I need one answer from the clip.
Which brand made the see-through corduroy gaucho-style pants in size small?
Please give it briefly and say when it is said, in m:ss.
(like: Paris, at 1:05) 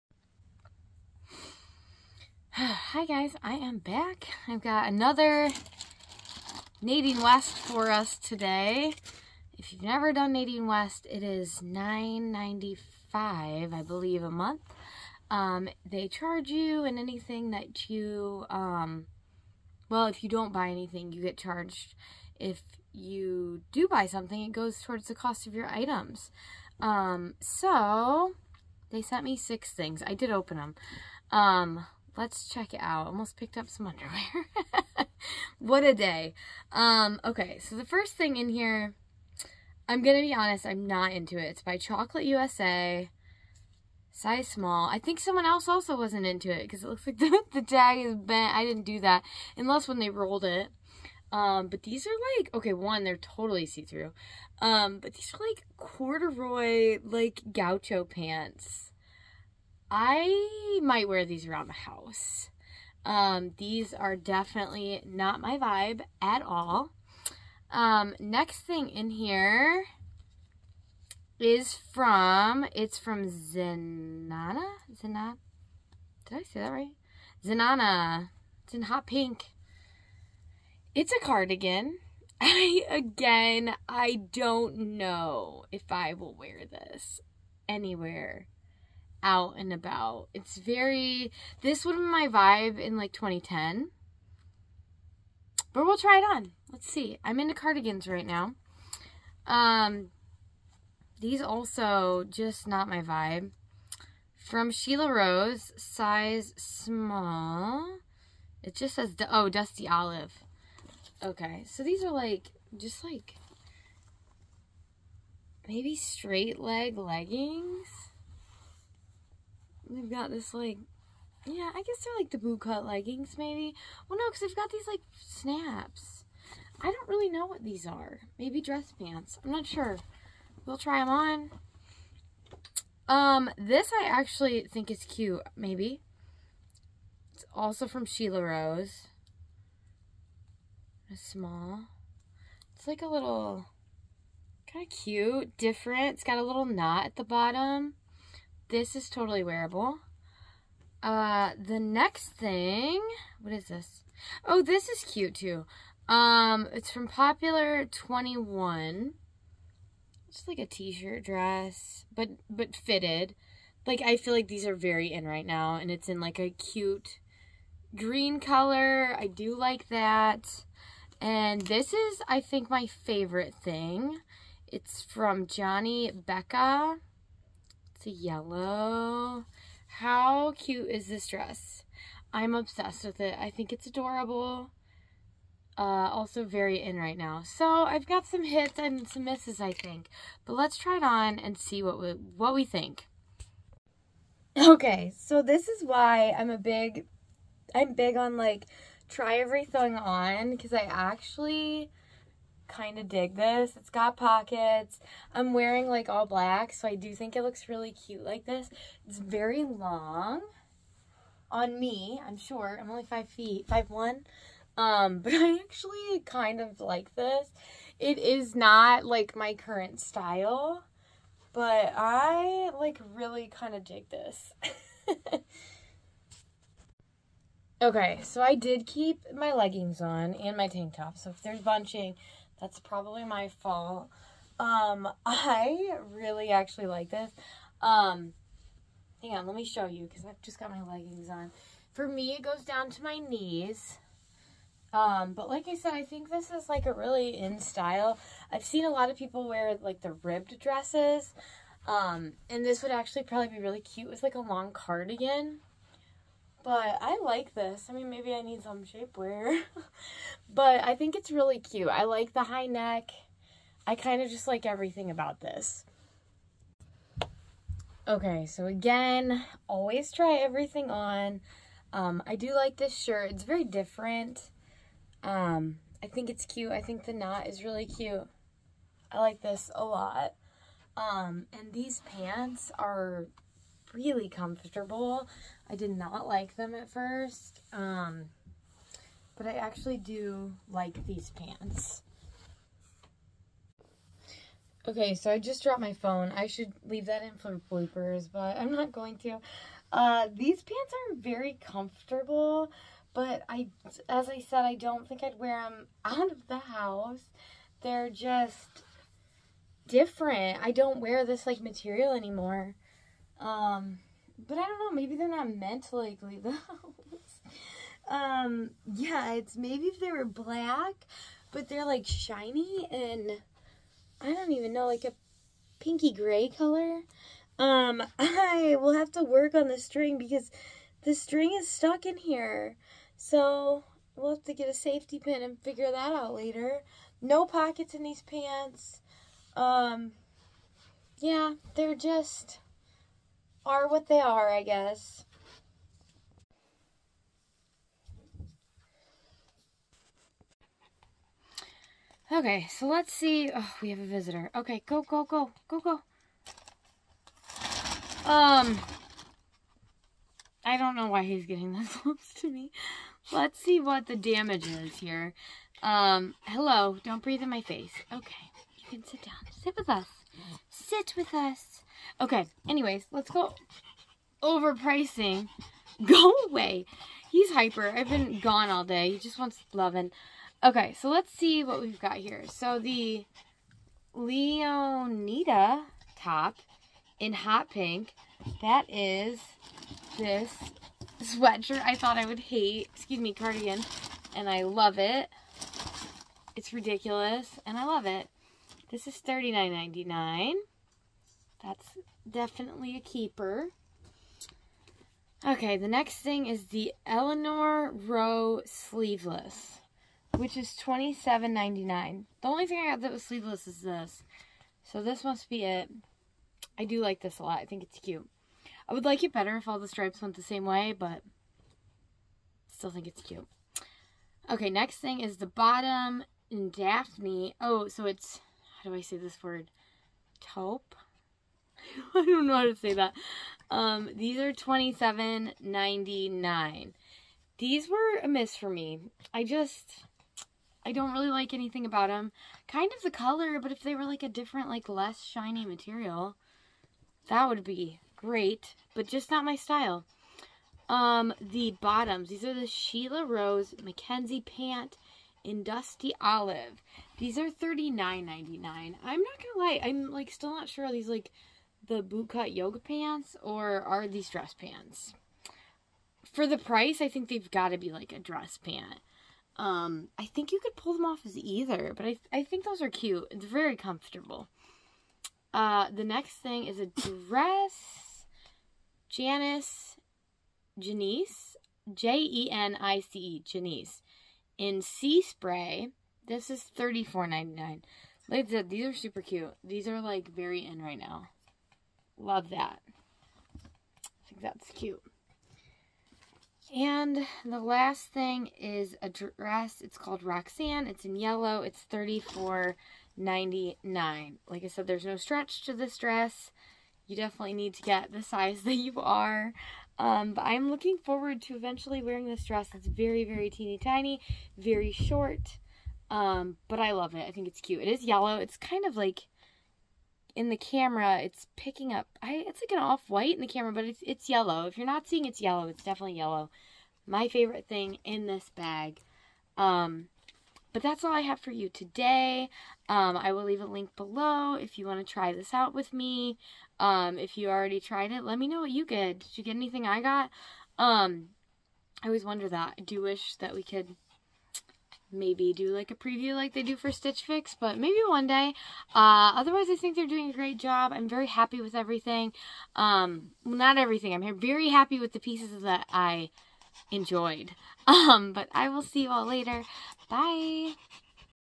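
Chocolate USA, at 0:41.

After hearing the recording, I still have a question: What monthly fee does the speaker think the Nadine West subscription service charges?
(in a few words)
$9.95.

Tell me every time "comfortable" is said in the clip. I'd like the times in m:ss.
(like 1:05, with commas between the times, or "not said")
4:44, 5:01, 7:53.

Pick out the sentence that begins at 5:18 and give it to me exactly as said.
um, yeah, it's maybe if they were black, but they're like shiny and I don't even know, like a pinky gray color.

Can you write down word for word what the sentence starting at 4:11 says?
Um, and this would actually probably be really cute with like a long cardigan.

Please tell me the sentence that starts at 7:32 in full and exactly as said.
These are the Sheila Rose Mackenzie pant in dusty olive.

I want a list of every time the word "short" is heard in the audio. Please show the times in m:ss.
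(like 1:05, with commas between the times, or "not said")
3:32, 8:34.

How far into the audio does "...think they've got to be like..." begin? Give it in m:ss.
7:47.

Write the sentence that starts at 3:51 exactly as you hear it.
So if there's bunching, that's probably my fault.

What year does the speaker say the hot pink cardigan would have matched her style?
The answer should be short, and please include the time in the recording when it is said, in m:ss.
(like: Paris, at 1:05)
2010, at 1:33.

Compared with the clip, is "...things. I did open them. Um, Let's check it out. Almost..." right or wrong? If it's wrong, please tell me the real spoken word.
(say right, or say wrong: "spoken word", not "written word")
right.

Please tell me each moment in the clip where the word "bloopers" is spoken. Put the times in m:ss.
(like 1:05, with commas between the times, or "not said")
4:57.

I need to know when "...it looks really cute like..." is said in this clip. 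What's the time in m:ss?
3:27.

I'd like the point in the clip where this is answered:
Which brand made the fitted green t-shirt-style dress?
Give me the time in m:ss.
2:37.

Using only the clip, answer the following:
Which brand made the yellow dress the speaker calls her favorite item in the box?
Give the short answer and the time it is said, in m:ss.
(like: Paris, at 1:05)
Johnny Becca, at 2:55.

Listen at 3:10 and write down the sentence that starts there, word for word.
But let's try it on and see what we, what we think.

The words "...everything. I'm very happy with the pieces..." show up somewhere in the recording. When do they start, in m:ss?
9:13.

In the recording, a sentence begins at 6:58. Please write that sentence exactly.
I would like it better if all the stripes went the same way, but still think it's cute.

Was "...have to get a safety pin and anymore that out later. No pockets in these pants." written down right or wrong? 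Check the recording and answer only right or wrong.
wrong.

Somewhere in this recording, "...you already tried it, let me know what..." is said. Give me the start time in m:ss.
8:57.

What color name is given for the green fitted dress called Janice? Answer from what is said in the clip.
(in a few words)
Sea Spray.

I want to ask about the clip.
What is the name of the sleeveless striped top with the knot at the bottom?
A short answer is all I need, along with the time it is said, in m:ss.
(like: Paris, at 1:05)
Eleanor Rowe, at 6:47.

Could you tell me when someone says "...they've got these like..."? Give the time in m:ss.
2:04.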